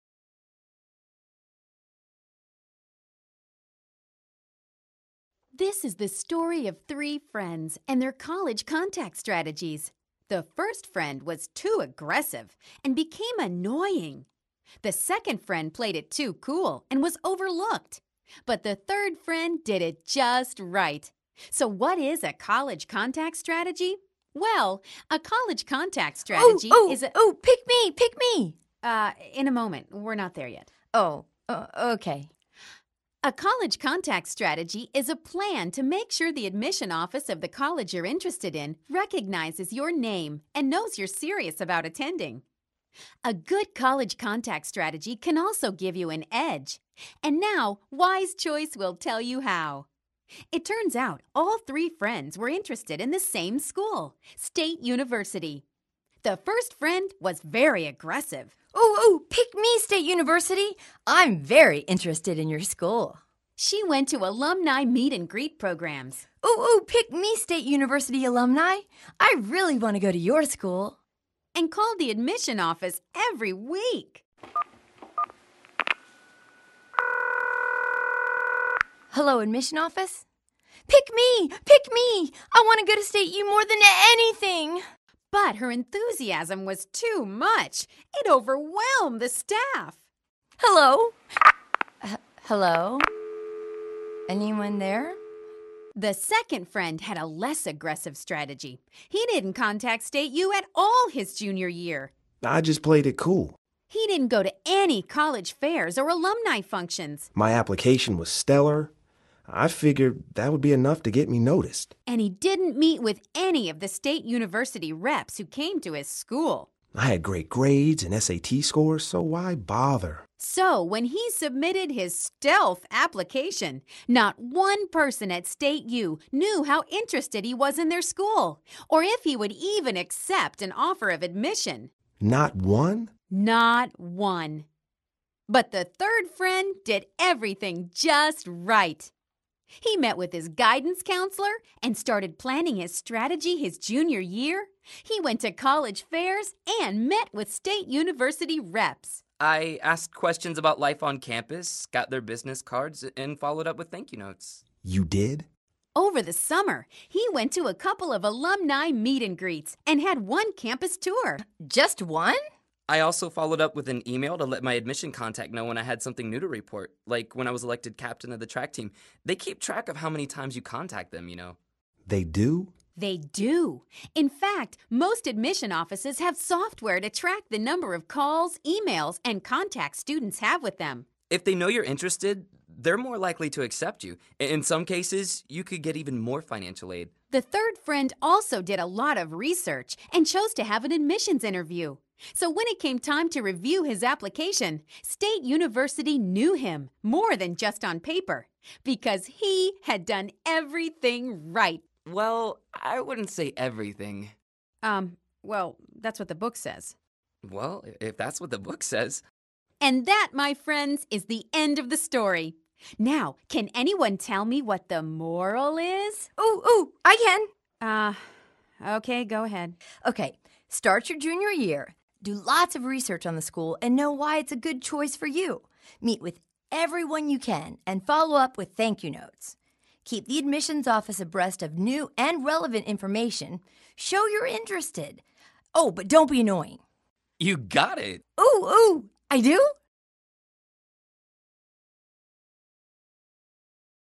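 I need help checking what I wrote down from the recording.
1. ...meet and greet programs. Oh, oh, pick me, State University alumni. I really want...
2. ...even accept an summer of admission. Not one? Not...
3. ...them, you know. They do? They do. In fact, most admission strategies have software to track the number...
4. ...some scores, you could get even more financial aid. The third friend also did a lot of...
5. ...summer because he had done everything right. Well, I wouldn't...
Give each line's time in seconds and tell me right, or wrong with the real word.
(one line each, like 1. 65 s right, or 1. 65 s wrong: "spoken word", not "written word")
1. 64 s right
2. 129 s wrong: "offer", not "summer"
3. 171 s wrong: "offices", not "strategies"
4. 184 s wrong: "cases", not "scores"
5. 197 s wrong: "paper", not "summer".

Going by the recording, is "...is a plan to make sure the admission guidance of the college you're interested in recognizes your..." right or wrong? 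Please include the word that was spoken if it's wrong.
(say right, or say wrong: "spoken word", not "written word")
wrong: "office", not "guidance".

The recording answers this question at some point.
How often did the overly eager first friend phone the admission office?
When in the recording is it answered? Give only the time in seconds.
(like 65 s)
73 s.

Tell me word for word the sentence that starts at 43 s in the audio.
A good college contact strategy can also give you an edge.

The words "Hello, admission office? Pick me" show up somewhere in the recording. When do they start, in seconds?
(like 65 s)
79 s.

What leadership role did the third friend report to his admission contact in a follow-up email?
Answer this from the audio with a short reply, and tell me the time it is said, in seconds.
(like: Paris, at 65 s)
captain of the track team, at 167 s.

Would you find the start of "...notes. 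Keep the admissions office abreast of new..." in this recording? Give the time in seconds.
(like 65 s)
229 s.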